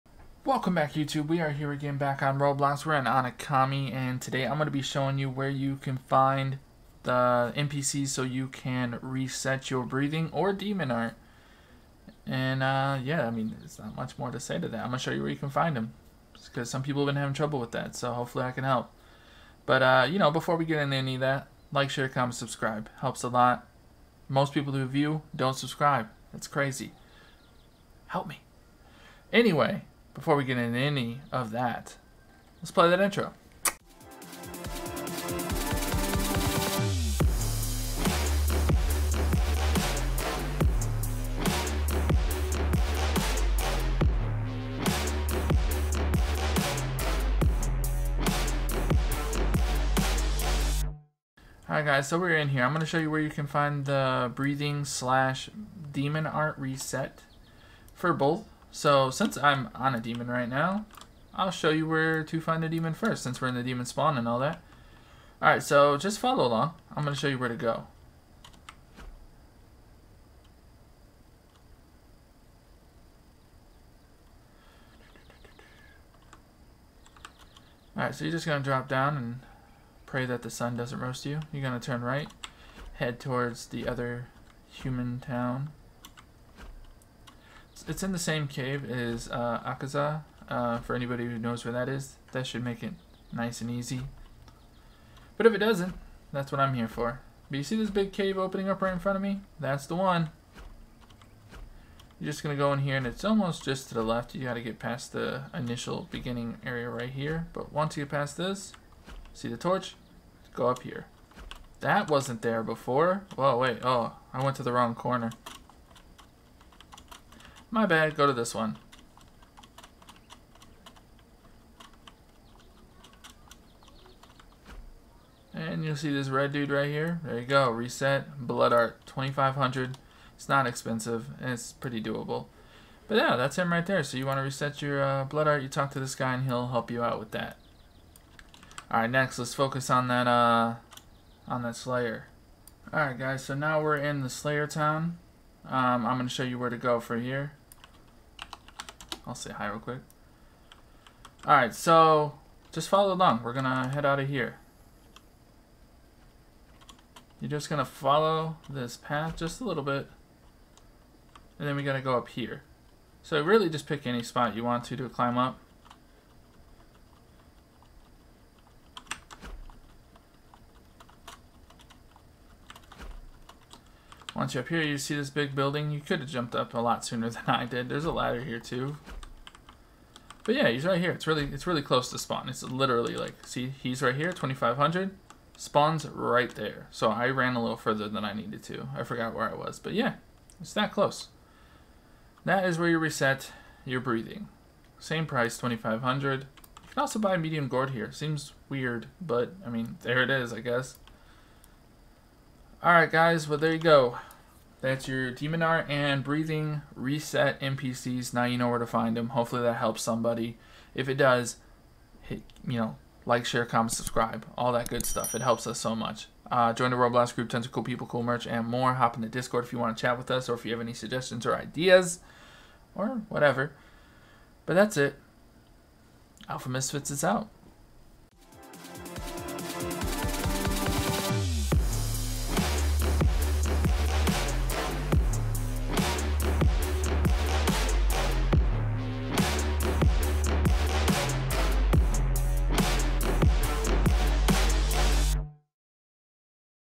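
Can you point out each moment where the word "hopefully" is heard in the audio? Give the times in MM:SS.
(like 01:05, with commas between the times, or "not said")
00:18, 03:29.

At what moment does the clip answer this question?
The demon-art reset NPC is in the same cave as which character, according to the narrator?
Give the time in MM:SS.
01:29.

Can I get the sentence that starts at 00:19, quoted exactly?
But uh, you know, before we get into any of that, like, share, comment, subscribe, helps a lot.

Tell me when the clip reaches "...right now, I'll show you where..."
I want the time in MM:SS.
01:00.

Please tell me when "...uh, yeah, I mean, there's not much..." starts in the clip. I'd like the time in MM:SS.
00:12.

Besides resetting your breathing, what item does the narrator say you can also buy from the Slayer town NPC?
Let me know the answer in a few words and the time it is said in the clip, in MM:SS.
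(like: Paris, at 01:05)
Medium gourd, at 03:17.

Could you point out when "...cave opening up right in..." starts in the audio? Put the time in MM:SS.
01:38.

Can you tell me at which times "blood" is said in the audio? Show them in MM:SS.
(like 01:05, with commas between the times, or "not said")
02:08, 02:15.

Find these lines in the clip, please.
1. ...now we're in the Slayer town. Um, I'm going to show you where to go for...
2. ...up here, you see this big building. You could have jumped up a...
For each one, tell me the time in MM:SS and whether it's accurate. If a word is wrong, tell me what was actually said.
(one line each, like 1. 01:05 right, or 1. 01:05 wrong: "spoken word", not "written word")
1. 02:23 right
2. 02:54 right.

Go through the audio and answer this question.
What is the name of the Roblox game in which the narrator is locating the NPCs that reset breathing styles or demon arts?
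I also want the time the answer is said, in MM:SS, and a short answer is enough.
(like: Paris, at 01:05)
Onikami, at 00:03.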